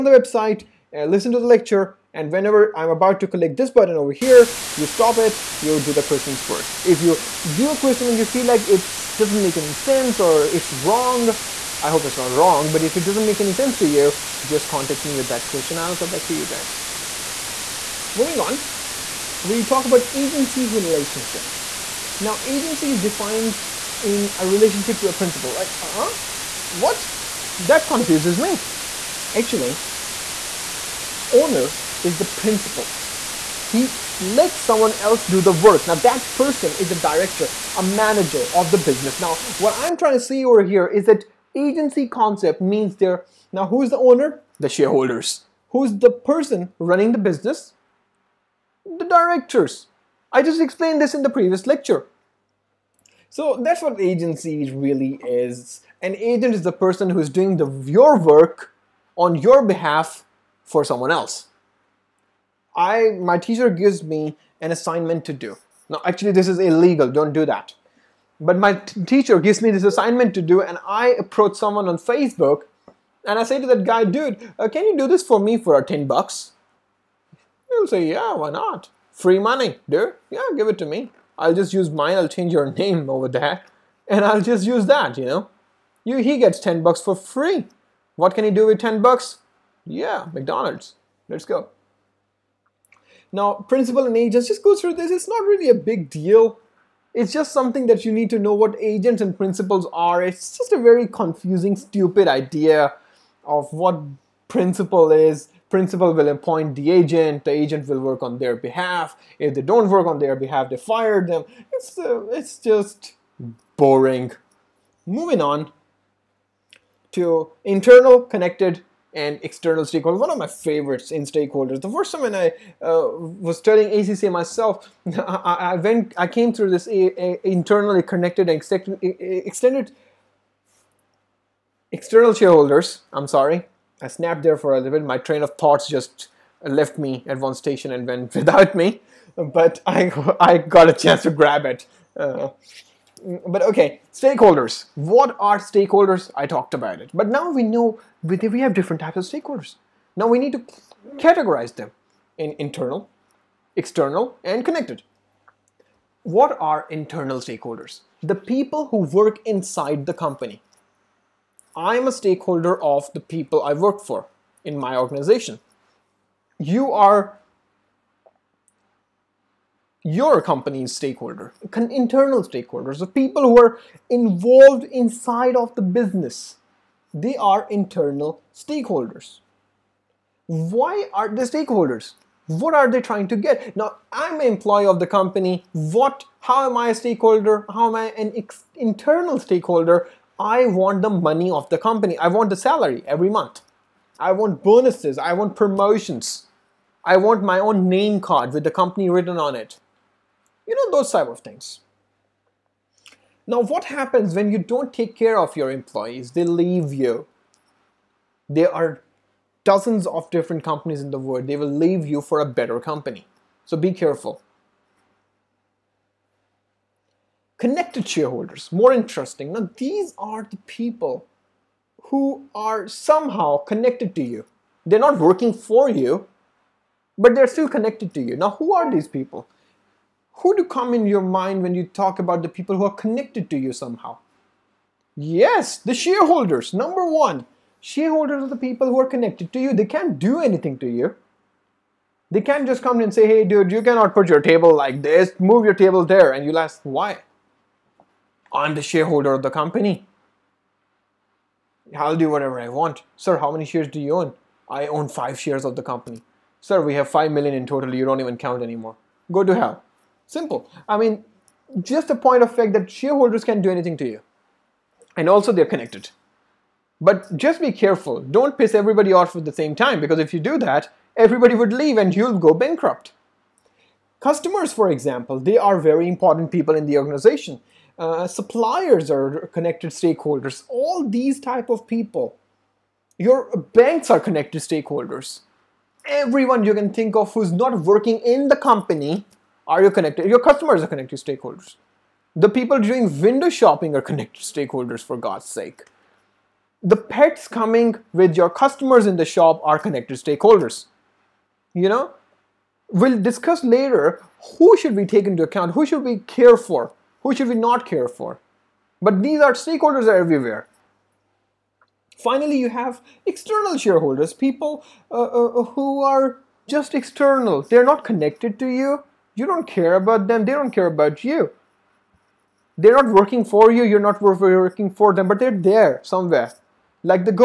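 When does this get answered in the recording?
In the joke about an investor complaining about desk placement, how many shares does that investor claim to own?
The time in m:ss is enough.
4:15.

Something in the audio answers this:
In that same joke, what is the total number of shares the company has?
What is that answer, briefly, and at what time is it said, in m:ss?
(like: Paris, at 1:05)
5 million, at 4:17.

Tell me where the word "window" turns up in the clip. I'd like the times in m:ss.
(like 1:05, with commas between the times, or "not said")
4:53.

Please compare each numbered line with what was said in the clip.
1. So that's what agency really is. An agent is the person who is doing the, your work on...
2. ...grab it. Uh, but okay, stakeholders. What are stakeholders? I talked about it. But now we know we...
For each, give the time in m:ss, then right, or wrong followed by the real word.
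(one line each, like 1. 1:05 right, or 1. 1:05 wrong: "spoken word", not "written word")
1. 0:53 right
2. 2:21 right.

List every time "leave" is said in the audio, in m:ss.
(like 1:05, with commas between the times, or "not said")
3:26, 3:31, 4:31.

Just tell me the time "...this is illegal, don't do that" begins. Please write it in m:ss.
1:06.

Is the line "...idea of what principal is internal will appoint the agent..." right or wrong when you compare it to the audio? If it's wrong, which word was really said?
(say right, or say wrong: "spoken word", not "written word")
wrong: "principal", not "internal".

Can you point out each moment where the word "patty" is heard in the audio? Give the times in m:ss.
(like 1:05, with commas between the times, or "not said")
not said.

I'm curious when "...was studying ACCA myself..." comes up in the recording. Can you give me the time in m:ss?
2:03.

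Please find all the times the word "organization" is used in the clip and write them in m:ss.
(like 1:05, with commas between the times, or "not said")
2:44, 4:36.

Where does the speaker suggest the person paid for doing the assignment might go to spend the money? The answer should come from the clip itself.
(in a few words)
McDonald's.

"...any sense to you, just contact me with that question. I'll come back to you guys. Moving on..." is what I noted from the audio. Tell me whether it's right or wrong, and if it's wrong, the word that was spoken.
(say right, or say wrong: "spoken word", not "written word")
right.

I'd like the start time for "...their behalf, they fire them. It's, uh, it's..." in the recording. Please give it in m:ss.
1:50.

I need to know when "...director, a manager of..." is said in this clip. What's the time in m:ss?
0:37.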